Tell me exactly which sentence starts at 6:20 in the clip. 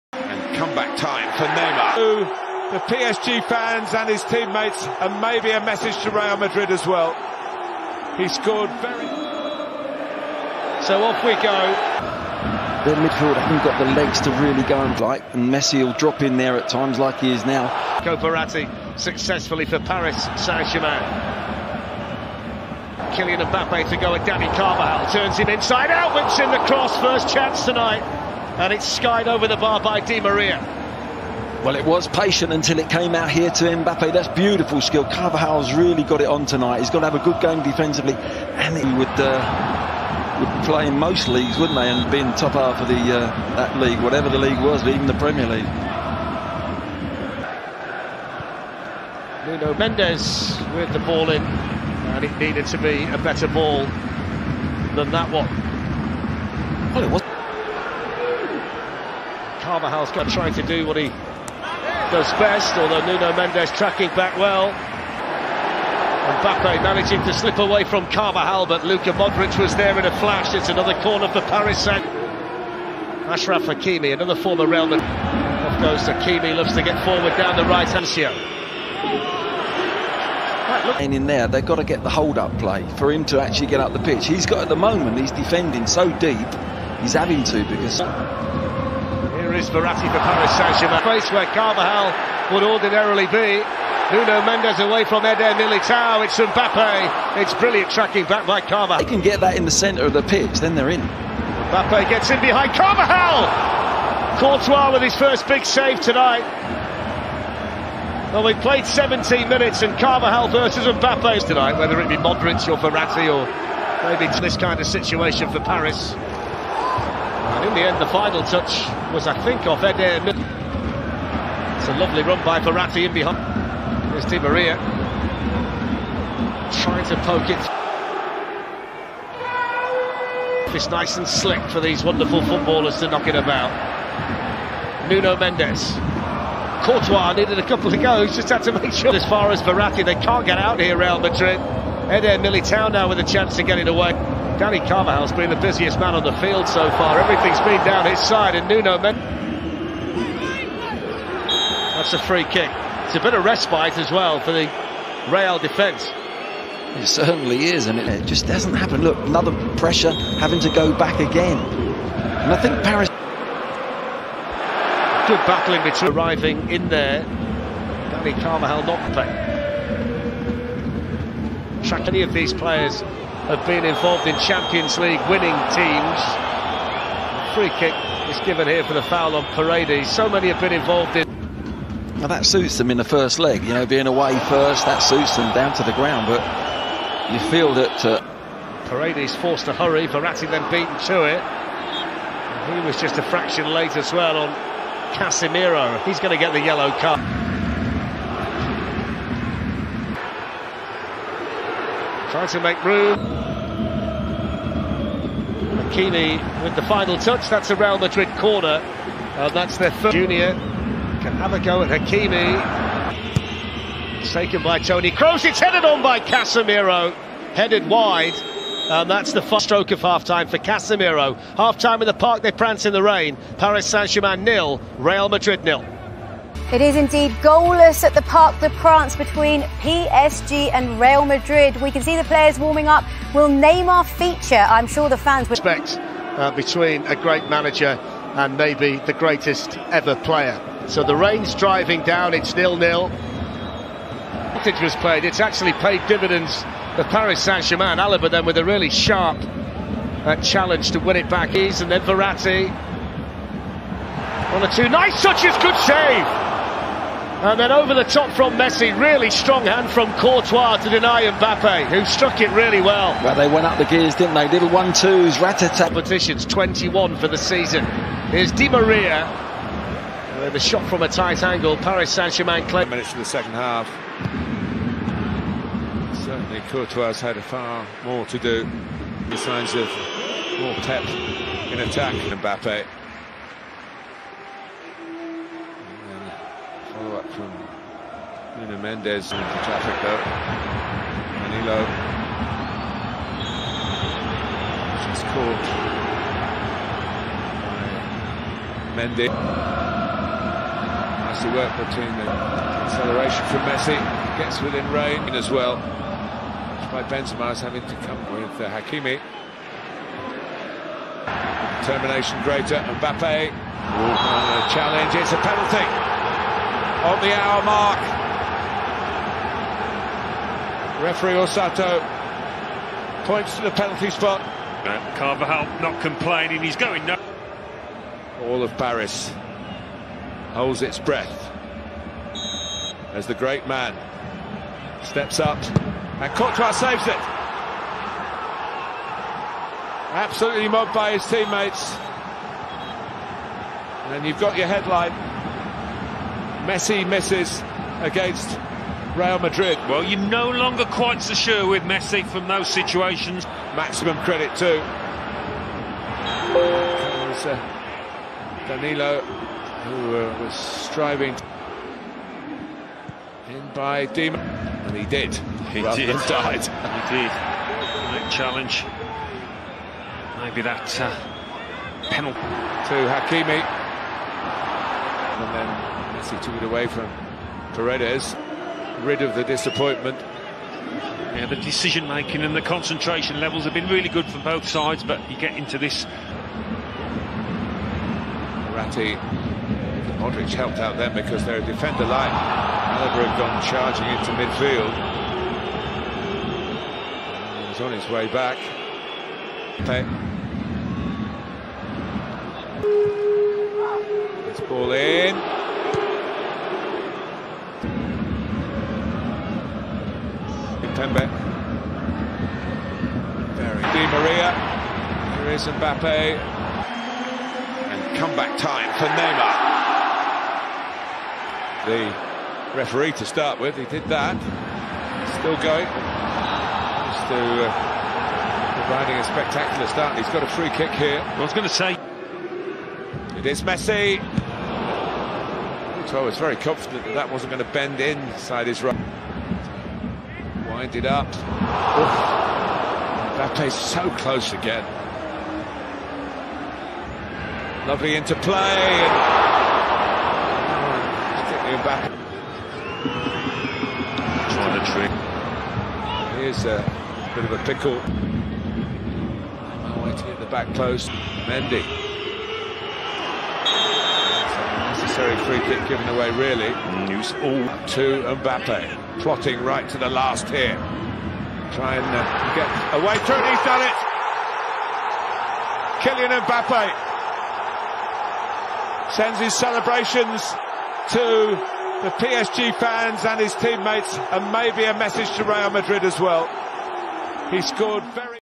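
Yeah, the decision making and the concentration levels have been really good from both sides, but you get into this.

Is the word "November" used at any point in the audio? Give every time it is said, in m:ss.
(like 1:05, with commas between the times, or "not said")
not said.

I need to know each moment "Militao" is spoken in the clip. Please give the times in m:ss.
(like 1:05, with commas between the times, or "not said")
1:35, 2:22.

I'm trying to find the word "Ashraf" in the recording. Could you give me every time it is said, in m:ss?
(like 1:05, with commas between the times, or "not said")
1:13.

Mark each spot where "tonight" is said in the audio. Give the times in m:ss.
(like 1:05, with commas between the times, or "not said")
0:27, 0:36, 1:45, 1:51.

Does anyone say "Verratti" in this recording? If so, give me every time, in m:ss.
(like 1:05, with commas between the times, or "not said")
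1:29, 1:52, 2:02, 2:19, 3:10, 4:12.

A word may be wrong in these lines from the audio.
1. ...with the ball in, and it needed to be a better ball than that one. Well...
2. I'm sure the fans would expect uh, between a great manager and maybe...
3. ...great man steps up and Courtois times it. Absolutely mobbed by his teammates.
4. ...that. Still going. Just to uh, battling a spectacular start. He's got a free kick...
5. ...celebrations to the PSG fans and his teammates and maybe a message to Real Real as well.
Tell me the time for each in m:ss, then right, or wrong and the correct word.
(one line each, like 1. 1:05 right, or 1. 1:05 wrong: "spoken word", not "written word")
1. 0:50 right
2. 3:54 right
3. 5:33 wrong: "saves", not "times"
4. 7:04 wrong: "providing", not "battling"
5. 7:59 wrong: "Madrid", not "Real".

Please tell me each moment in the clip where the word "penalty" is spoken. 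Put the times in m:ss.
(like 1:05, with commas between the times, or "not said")
5:15, 5:23, 6:12.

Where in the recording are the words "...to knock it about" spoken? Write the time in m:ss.
2:13.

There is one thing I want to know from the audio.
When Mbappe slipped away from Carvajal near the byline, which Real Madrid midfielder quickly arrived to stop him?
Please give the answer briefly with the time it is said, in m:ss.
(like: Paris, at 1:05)
Luka Modric, at 1:08.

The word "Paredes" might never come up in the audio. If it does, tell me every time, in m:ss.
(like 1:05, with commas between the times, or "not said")
2:59, 3:08, 6:17.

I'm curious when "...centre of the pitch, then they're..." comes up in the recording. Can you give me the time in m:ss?
1:39.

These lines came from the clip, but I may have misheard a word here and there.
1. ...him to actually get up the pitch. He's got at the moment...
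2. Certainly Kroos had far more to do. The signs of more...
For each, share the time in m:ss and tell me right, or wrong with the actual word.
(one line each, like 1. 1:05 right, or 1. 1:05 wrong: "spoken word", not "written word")
1. 1:23 right
2. 4:36 wrong: "Courtois", not "Kroos".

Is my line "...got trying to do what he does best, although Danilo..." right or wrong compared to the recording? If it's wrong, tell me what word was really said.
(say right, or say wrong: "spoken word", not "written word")
wrong: "Nuno", not "Danilo".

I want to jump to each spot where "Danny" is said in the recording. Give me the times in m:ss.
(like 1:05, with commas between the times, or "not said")
0:24, 2:24, 2:48.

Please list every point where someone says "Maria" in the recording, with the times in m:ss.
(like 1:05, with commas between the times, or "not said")
0:30, 2:04, 4:28, 6:54.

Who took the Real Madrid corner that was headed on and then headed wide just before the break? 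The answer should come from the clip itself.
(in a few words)
Tony Kroos.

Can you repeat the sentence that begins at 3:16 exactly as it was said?
He's going to get the yellow card.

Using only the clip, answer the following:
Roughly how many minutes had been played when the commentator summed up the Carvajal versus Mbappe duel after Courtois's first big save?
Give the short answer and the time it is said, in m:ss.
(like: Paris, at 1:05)
17, at 1:48.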